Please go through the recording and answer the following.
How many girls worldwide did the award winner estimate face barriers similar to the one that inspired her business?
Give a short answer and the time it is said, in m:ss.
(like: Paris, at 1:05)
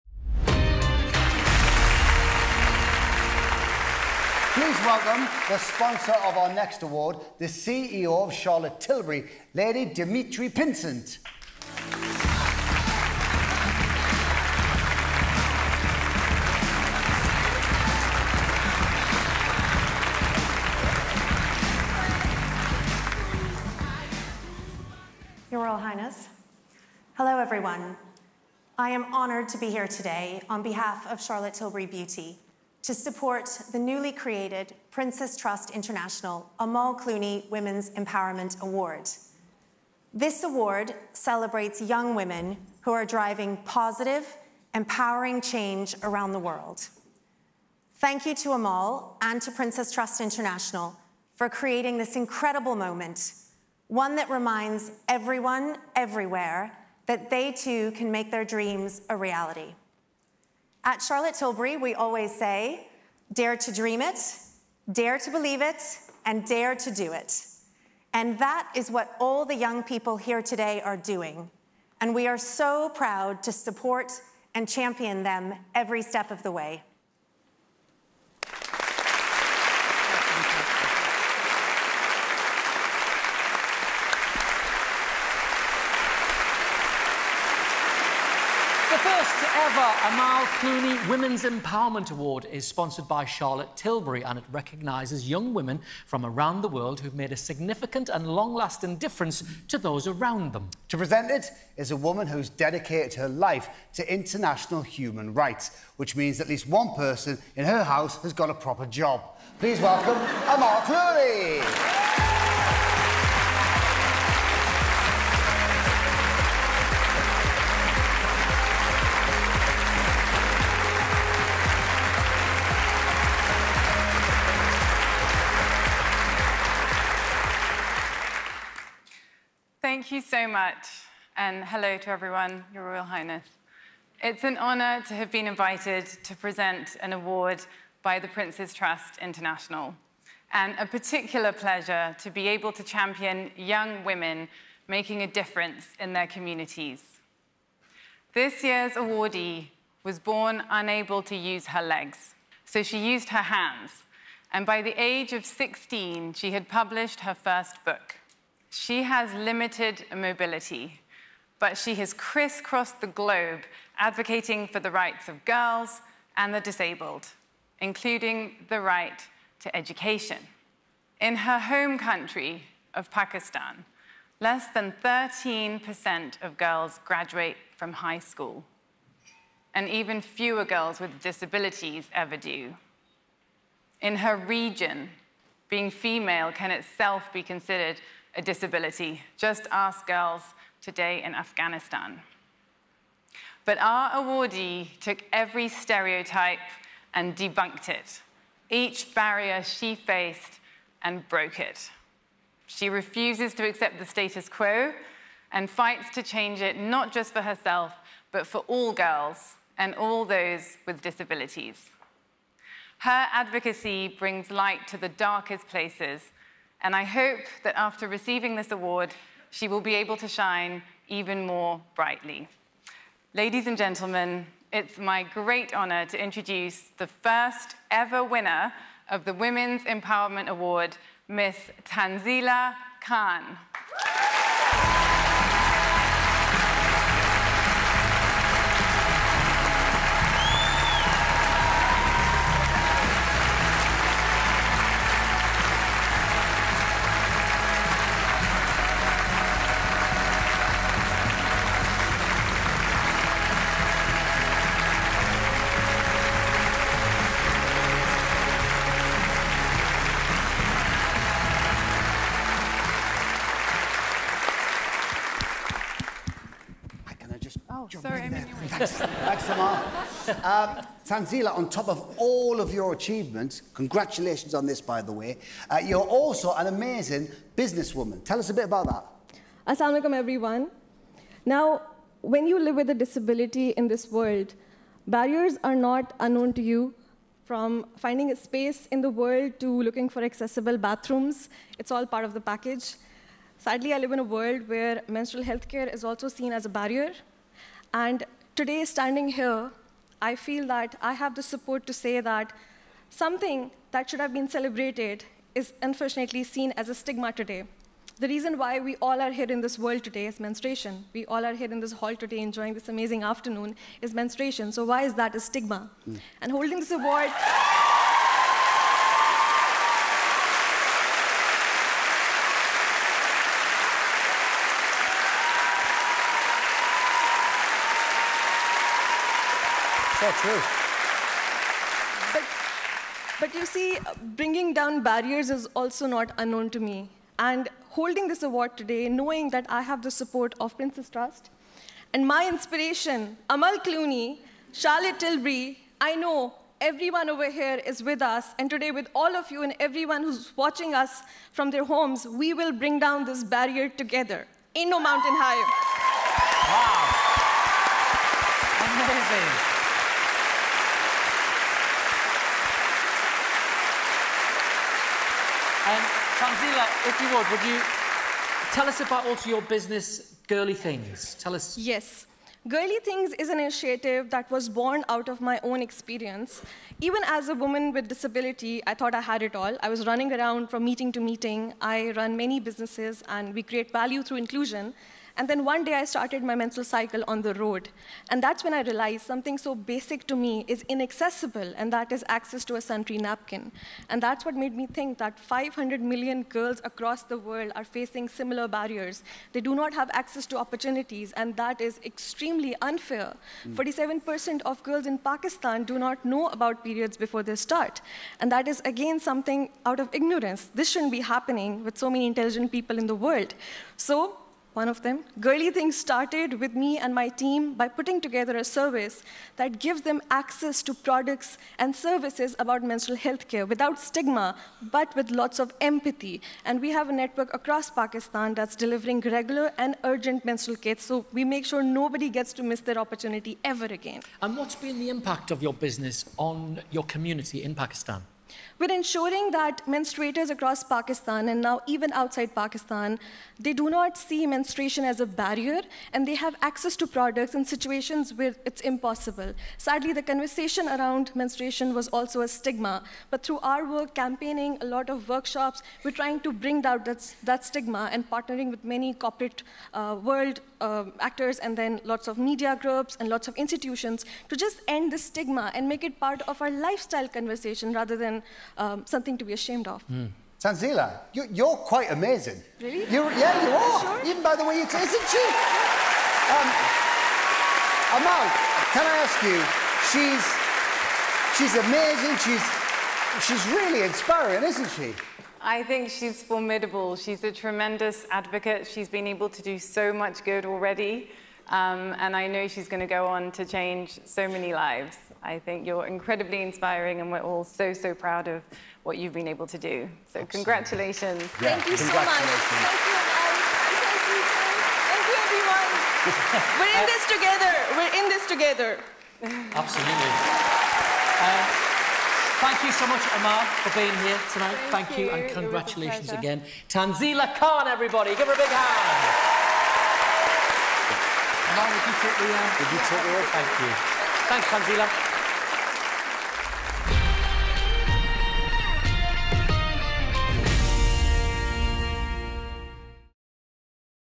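500 million, at 6:35.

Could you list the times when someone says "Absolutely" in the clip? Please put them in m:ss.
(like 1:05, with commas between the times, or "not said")
8:20, 8:29.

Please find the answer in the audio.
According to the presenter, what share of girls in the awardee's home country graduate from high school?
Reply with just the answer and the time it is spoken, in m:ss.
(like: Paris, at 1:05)
less than 13%, at 2:54.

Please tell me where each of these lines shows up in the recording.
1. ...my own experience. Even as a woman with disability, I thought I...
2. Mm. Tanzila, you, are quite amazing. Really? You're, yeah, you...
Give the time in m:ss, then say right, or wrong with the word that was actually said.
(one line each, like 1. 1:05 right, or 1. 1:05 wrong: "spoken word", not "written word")
1. 6:15 right
2. 7:50 right.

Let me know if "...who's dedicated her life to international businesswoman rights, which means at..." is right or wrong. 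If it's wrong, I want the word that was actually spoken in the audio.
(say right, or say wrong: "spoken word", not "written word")
wrong: "human", not "businesswoman".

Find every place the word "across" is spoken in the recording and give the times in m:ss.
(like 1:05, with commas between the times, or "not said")
6:36, 7:07, 7:20.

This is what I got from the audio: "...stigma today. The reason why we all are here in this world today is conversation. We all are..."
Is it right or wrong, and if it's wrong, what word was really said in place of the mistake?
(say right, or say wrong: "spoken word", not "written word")
wrong: "menstruation", not "conversation".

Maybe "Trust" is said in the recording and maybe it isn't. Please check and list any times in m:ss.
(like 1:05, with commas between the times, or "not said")
0:35, 0:49, 2:18, 5:41.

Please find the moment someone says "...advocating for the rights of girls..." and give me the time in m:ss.
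2:43.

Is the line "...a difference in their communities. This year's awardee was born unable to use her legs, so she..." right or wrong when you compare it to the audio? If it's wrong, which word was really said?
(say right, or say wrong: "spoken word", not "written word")
right.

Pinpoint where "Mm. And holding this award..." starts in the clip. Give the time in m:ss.
5:16.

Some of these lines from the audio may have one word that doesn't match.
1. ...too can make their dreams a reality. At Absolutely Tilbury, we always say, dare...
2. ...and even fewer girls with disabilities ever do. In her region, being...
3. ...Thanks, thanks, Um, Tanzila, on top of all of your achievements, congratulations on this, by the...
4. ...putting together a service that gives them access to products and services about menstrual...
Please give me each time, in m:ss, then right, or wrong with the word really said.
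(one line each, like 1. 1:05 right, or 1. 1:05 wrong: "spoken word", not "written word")
1. 0:57 wrong: "Charlotte", not "Absolutely"
2. 2:59 right
3. 4:28 right
4. 6:57 right.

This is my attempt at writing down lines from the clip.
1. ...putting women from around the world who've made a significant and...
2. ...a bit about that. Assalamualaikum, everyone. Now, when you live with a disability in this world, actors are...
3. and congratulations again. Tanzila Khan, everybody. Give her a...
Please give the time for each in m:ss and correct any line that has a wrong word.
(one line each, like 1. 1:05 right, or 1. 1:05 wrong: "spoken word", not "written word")
1. 1:35 wrong: "young", not "putting"
2. 4:38 wrong: "barriers", not "actors"
3. 8:35 right.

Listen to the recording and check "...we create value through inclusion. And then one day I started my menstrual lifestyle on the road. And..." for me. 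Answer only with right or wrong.
wrong.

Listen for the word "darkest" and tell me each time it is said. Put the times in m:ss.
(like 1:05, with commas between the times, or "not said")
3:35.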